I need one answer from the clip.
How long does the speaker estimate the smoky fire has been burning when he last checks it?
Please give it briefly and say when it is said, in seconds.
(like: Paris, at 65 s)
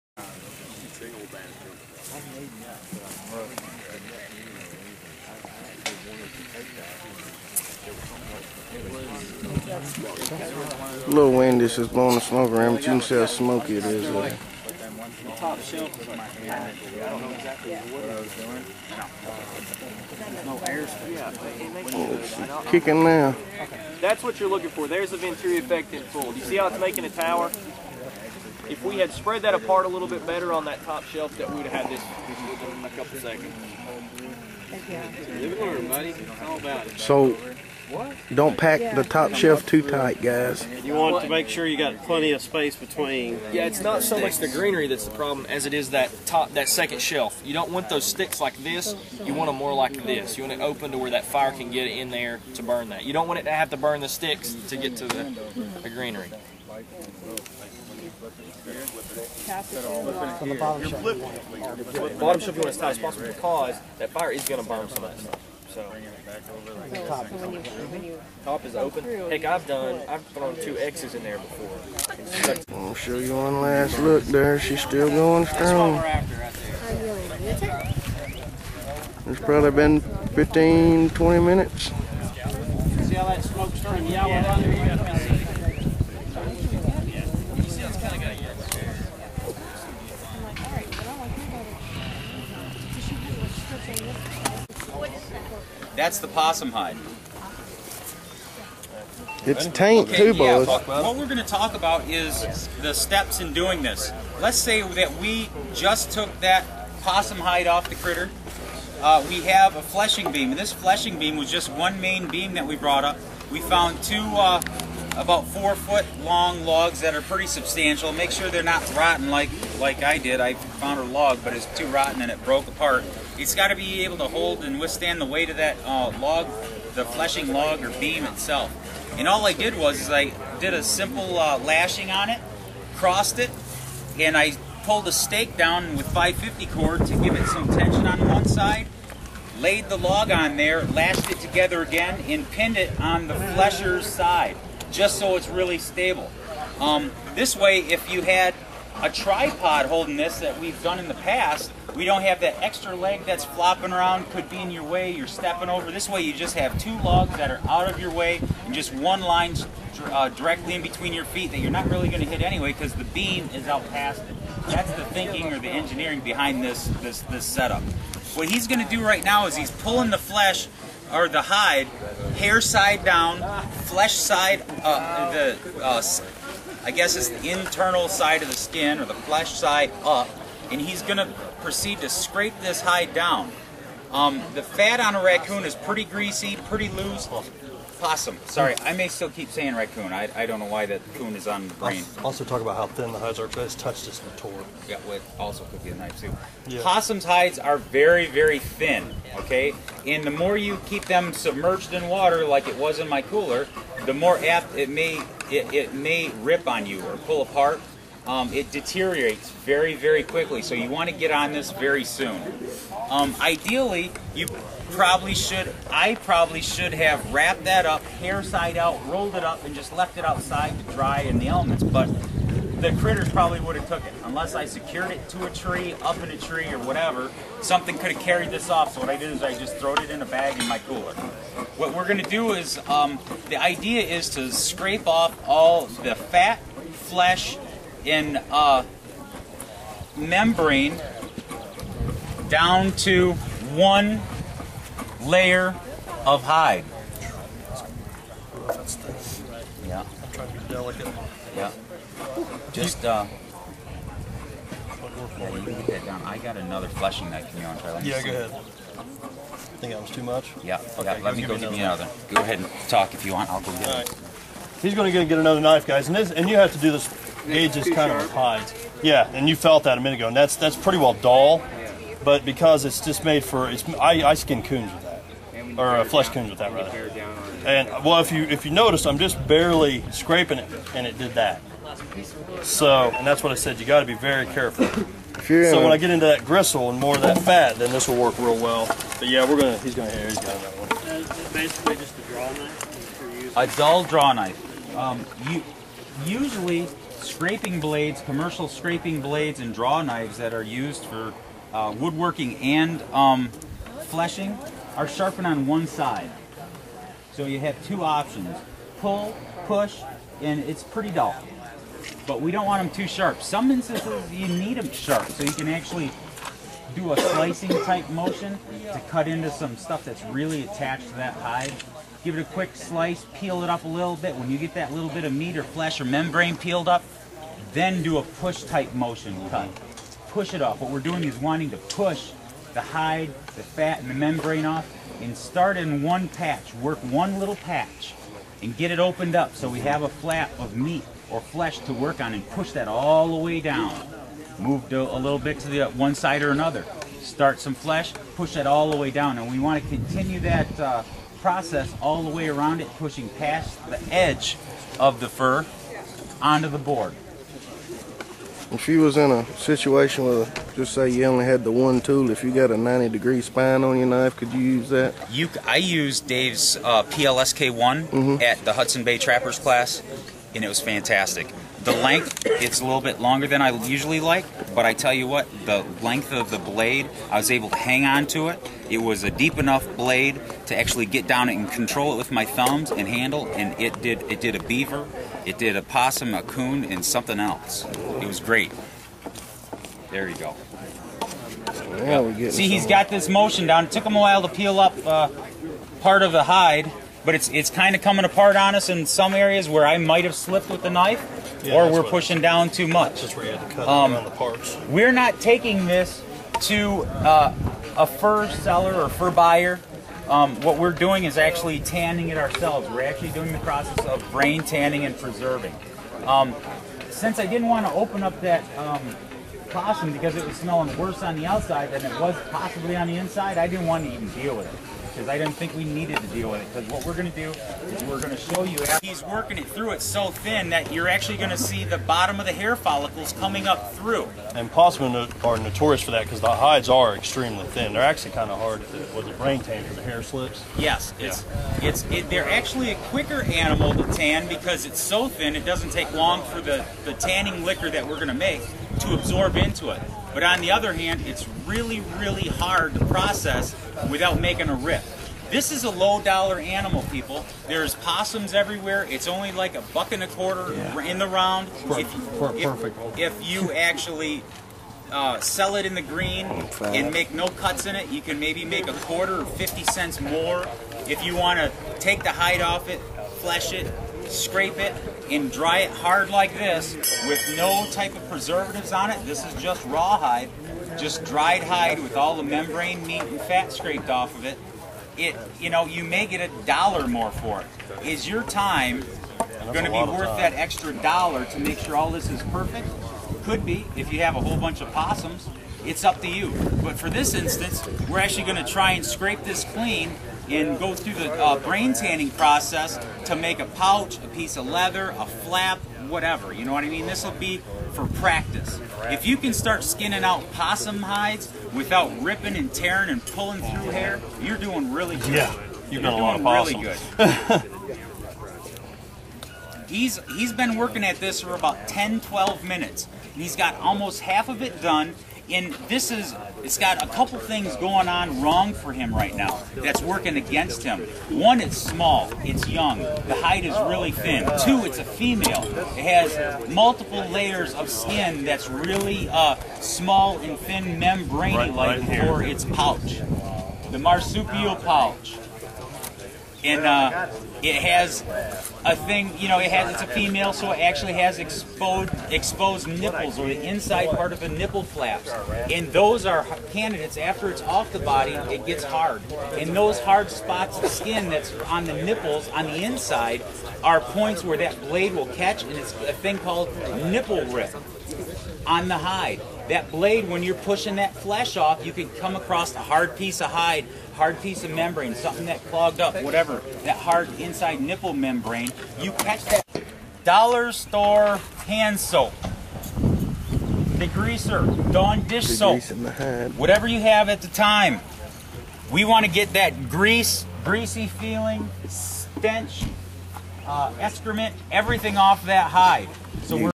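15 to 20 minutes, at 80 s.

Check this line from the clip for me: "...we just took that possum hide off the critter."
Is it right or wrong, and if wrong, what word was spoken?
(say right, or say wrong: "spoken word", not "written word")
right.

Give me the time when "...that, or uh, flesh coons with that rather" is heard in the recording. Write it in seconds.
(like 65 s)
275 s.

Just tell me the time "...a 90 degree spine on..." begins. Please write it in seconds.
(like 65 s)
362 s.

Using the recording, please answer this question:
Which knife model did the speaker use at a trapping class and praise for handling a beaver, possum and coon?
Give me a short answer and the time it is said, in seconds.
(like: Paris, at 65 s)
PLSK1, at 367 s.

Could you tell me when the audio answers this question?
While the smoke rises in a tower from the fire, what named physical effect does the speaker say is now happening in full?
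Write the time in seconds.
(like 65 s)
25 s.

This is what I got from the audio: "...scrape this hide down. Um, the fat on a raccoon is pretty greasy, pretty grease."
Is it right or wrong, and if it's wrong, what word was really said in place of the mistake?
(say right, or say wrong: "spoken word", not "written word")
wrong: "loose", not "grease".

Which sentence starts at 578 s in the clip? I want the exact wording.
You catch that dollar store hand soap, degreaser, Dawn dish soap, whatever you have at the time.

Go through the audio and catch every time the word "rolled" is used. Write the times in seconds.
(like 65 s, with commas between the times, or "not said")
219 s.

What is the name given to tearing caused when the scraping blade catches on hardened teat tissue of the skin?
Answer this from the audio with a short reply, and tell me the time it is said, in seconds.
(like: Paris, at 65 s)
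nipple rip, at 567 s.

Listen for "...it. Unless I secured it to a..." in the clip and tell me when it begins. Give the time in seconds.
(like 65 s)
224 s.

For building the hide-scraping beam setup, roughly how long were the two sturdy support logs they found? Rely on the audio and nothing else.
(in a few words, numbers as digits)
about 4 feet.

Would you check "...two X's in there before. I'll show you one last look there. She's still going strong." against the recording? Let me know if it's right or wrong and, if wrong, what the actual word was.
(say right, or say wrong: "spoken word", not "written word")
right.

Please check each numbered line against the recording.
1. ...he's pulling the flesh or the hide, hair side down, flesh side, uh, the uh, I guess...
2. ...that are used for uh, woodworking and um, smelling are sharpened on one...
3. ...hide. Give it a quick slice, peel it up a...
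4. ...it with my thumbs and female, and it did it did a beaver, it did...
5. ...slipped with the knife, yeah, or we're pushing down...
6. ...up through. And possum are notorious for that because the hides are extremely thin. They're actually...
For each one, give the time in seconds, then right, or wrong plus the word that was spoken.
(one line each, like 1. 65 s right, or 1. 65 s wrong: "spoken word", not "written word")
1. 169 s right
2. 300 s wrong: "fleshing", not "smelling"
3. 321 s right
4. 382 s wrong: "handle", not "female"
5. 400 s right
6. 433 s right.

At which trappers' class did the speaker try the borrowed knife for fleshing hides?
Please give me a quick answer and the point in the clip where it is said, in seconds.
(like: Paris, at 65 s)
Hudson Bay Trappers class, at 368 s.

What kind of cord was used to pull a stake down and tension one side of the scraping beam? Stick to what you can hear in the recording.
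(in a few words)
550 cord.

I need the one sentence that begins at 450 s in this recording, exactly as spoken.
But on the other hand, it's really, really hard to process without making a rip.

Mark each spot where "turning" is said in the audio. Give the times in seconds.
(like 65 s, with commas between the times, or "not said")
83 s.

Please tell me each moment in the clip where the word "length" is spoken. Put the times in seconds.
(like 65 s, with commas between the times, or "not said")
371 s, 376 s.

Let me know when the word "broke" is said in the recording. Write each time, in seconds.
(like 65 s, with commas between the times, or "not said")
122 s.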